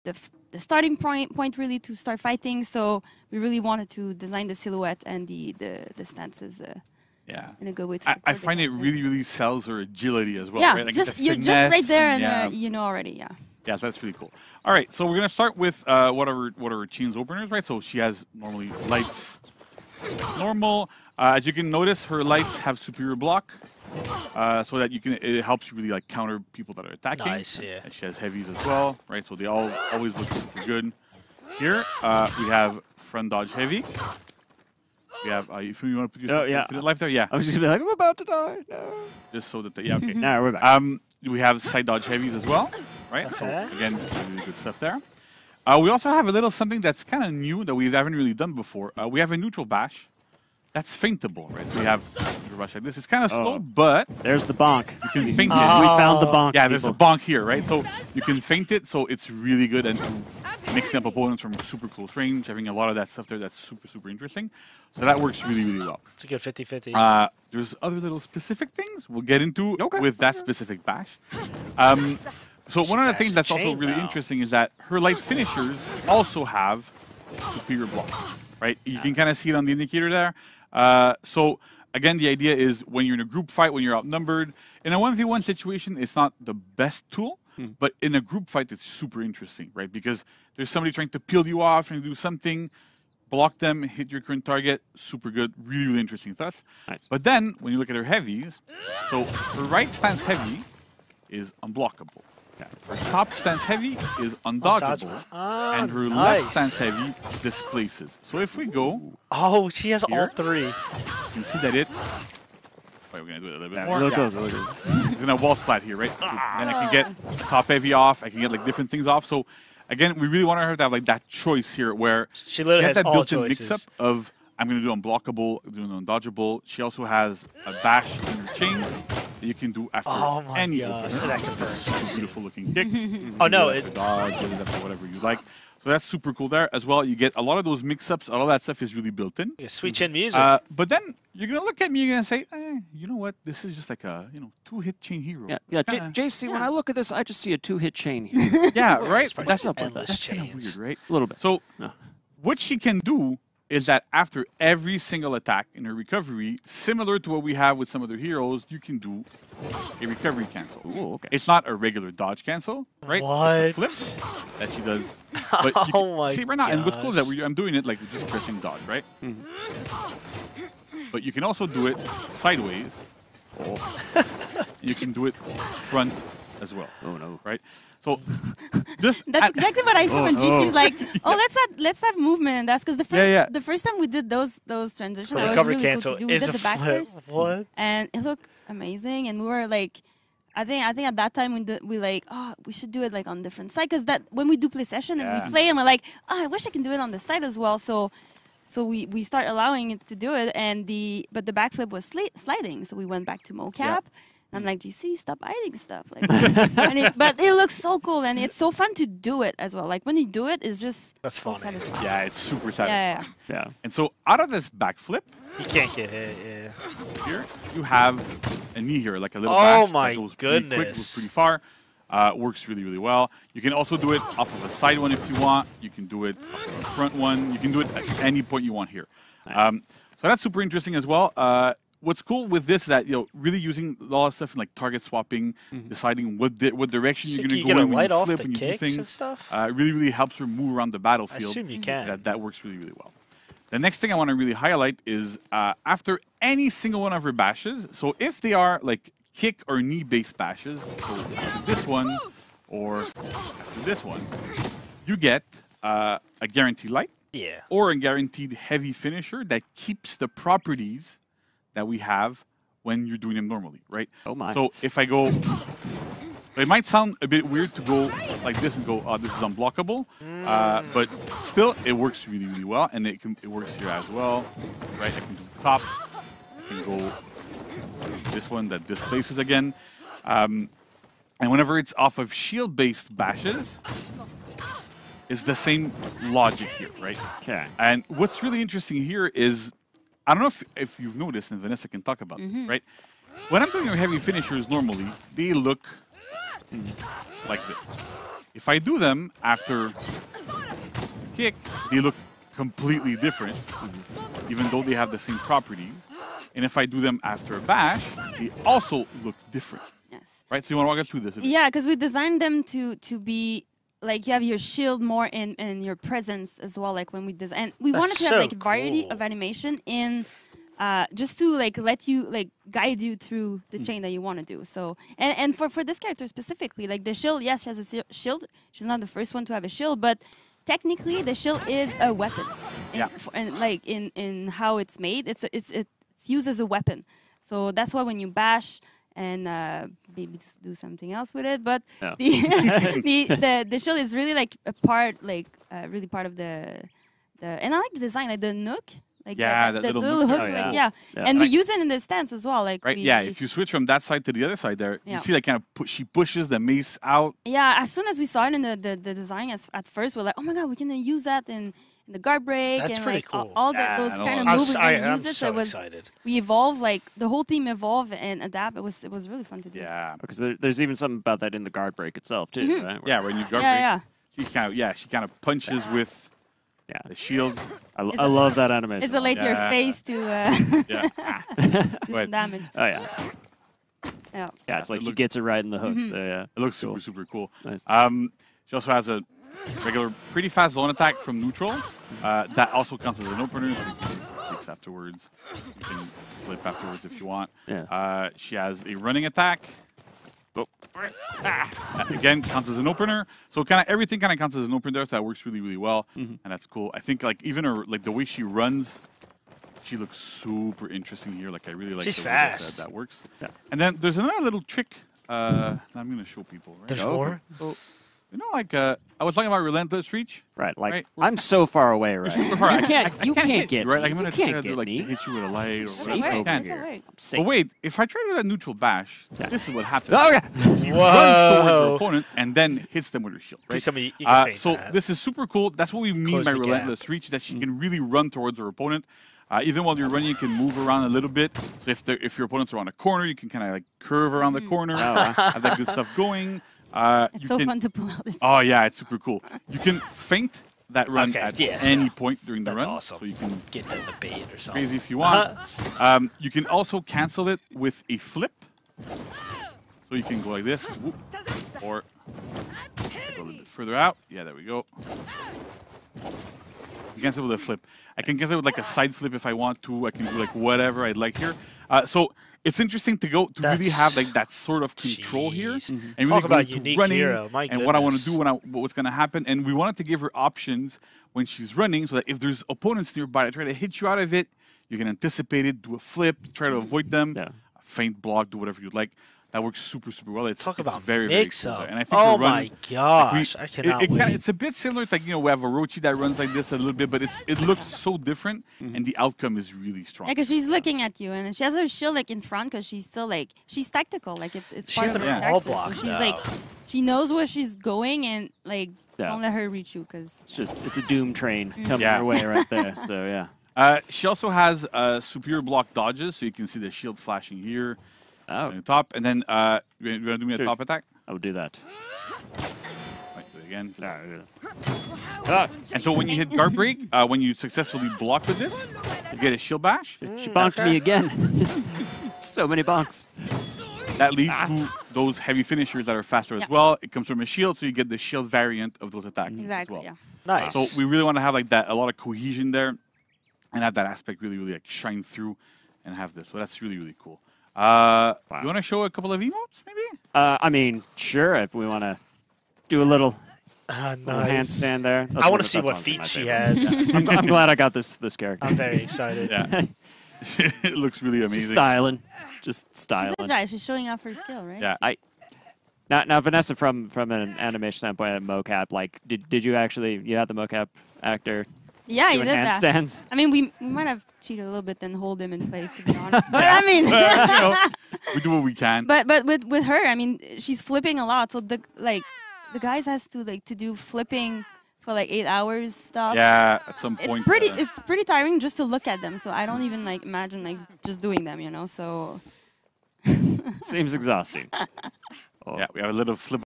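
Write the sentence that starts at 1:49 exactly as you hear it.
Oh, she has here, all three.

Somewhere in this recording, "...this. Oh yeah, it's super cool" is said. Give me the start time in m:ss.
7:28.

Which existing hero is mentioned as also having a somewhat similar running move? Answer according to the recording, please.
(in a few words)
Orochi.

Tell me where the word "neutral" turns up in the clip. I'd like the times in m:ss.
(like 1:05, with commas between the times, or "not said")
0:49, 6:31, 7:08.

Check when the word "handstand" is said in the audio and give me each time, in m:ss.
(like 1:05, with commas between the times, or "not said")
9:14, 9:32.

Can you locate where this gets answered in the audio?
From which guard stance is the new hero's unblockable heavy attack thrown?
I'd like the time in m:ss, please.
1:39.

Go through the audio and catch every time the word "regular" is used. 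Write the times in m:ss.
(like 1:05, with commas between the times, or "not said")
2:41, 6:29.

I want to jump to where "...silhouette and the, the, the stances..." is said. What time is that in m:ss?
0:04.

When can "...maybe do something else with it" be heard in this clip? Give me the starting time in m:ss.
5:40.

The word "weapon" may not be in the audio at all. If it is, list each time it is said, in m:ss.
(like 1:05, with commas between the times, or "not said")
5:32, 5:36.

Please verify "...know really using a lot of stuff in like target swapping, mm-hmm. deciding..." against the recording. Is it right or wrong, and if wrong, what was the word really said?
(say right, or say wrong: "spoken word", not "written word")
right.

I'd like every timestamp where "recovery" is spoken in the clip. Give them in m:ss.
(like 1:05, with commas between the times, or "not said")
2:35, 2:40.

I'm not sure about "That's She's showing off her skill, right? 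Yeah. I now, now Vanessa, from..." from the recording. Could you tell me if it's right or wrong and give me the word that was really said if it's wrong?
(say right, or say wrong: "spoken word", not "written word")
right.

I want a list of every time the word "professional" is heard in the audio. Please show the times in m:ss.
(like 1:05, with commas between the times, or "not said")
not said.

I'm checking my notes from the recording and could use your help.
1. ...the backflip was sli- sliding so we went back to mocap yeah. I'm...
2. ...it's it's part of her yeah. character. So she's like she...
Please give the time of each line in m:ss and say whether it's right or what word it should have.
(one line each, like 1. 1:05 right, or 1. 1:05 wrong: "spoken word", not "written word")
1. 3:21 right
2. 8:24 right.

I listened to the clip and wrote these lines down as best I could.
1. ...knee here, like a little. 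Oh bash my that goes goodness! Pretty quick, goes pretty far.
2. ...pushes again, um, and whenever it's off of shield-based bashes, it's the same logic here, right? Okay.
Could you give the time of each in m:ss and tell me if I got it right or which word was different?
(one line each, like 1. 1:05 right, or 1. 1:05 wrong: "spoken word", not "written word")
1. 3:38 right
2. 4:38 wrong: "displaces", not "pushes".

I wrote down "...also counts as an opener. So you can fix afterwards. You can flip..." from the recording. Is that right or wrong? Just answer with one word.
right.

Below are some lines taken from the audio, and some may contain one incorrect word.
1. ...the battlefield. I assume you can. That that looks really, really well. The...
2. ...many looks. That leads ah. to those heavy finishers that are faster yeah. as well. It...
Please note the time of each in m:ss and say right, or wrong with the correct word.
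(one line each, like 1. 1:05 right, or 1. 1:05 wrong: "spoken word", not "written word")
1. 4:00 wrong: "works", not "looks"
2. 8:52 wrong: "bonks", not "looks".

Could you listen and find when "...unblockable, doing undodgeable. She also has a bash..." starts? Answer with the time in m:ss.
2:04.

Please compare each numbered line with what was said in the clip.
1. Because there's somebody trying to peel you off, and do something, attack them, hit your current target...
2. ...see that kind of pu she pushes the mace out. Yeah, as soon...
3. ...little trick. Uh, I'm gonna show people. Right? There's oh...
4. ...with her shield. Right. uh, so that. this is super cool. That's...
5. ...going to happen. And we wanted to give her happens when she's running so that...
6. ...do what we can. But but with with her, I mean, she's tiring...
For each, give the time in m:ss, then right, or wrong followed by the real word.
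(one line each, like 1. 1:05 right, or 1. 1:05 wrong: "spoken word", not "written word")
1. 1:29 wrong: "block", not "attack"
2. 5:55 right
3. 6:54 right
4. 7:13 right
5. 7:58 wrong: "options", not "happens"
6. 9:38 wrong: "flipping", not "tiring".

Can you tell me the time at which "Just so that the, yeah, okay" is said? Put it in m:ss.
0:39.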